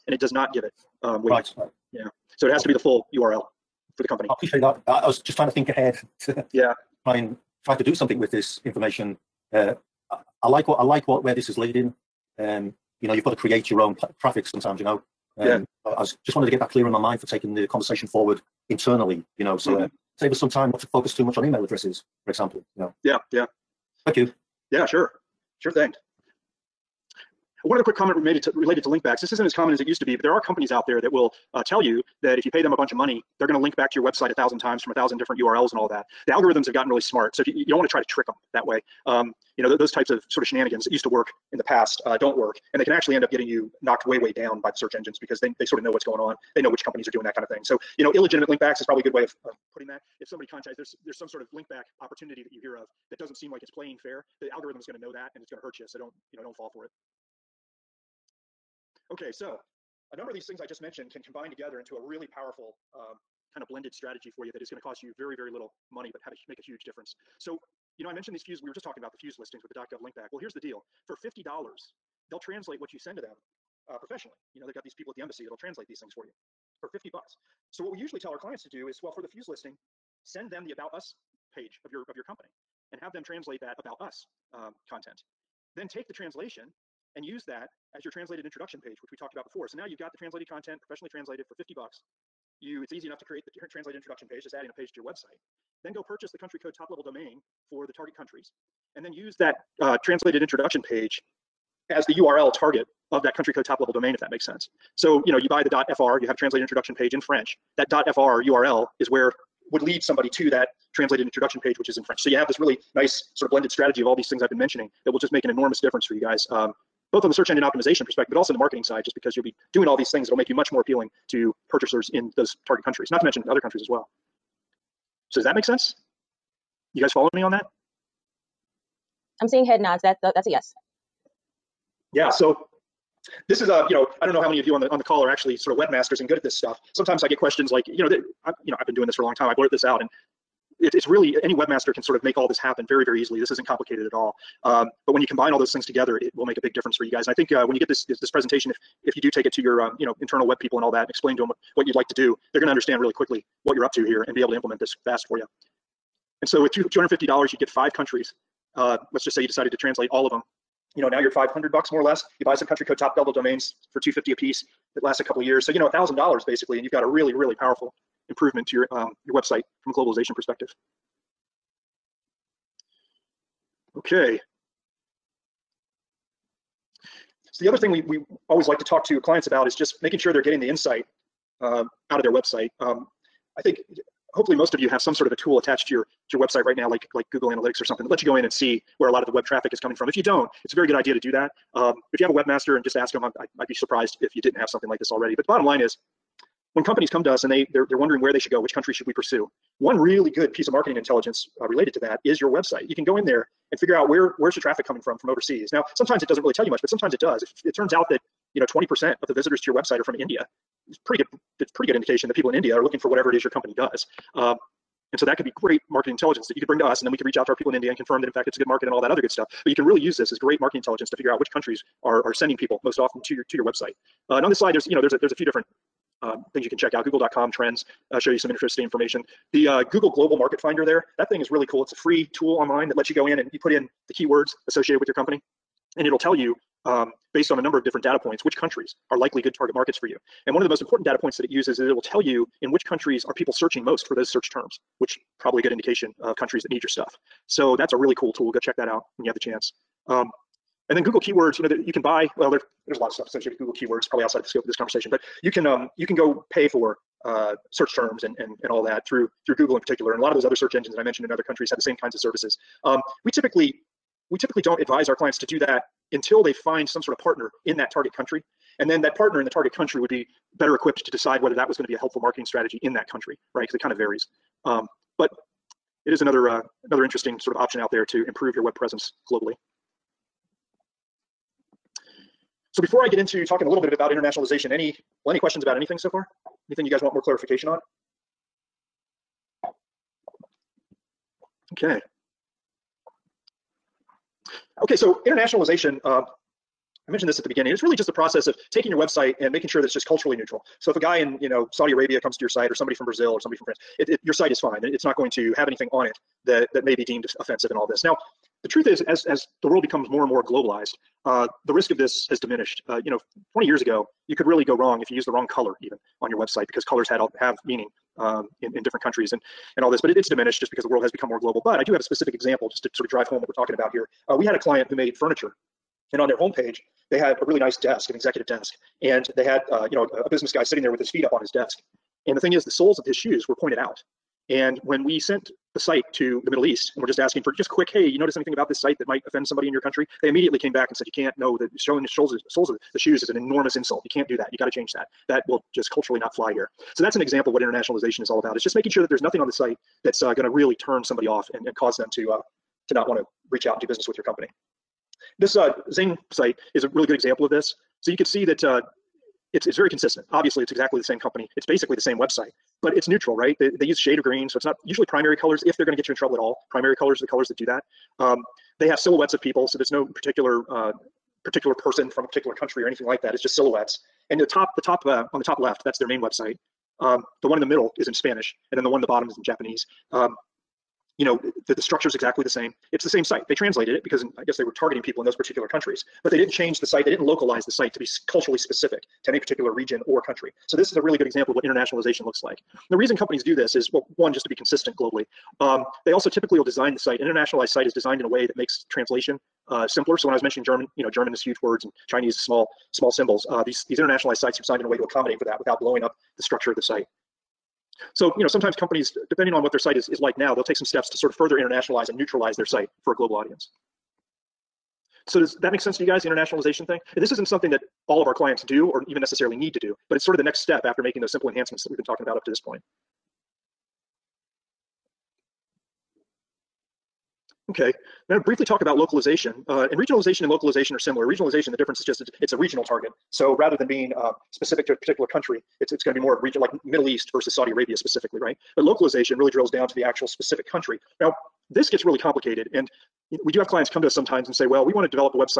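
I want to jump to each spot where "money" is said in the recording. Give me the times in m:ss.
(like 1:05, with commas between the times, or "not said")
0:33, 1:05.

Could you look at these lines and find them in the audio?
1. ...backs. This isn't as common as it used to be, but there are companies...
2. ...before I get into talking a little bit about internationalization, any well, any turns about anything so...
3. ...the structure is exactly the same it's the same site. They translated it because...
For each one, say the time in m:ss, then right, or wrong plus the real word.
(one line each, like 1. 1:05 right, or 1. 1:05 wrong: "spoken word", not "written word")
1. 0:29 right
2. 4:42 wrong: "questions", not "turns"
3. 6:21 right.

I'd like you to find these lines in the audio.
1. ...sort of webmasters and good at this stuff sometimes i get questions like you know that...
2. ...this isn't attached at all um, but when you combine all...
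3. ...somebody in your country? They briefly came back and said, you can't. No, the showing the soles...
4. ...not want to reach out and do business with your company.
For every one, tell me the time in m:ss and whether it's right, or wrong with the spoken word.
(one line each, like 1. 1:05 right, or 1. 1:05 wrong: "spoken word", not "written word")
1. 2:15 right
2. 2:23 wrong: "complicated", not "attached"
3. 5:39 wrong: "immediately", not "briefly"
4. 5:52 right.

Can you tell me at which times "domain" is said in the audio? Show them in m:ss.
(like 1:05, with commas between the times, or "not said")
1:37, 1:43, 2:43.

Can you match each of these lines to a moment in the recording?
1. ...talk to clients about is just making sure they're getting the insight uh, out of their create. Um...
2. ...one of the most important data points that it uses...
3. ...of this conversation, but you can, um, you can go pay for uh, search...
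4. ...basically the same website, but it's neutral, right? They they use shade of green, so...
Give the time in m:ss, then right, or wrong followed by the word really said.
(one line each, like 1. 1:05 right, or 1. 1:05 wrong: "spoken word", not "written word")
1. 2:58 wrong: "website", not "create"
2. 4:00 right
3. 4:14 right
4. 6:01 right.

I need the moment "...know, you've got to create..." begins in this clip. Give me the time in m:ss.
0:13.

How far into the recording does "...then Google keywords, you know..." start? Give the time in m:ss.
4:10.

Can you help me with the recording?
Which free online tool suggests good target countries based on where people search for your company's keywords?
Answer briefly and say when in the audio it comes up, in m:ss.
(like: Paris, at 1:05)
Google Global Market Finder, at 3:49.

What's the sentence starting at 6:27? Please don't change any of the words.
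They didn't localize the site to be culturally specific to any particular region or country.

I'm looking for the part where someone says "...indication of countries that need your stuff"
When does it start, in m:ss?
4:05.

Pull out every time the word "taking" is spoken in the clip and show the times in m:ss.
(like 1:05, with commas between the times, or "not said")
0:17, 4:58.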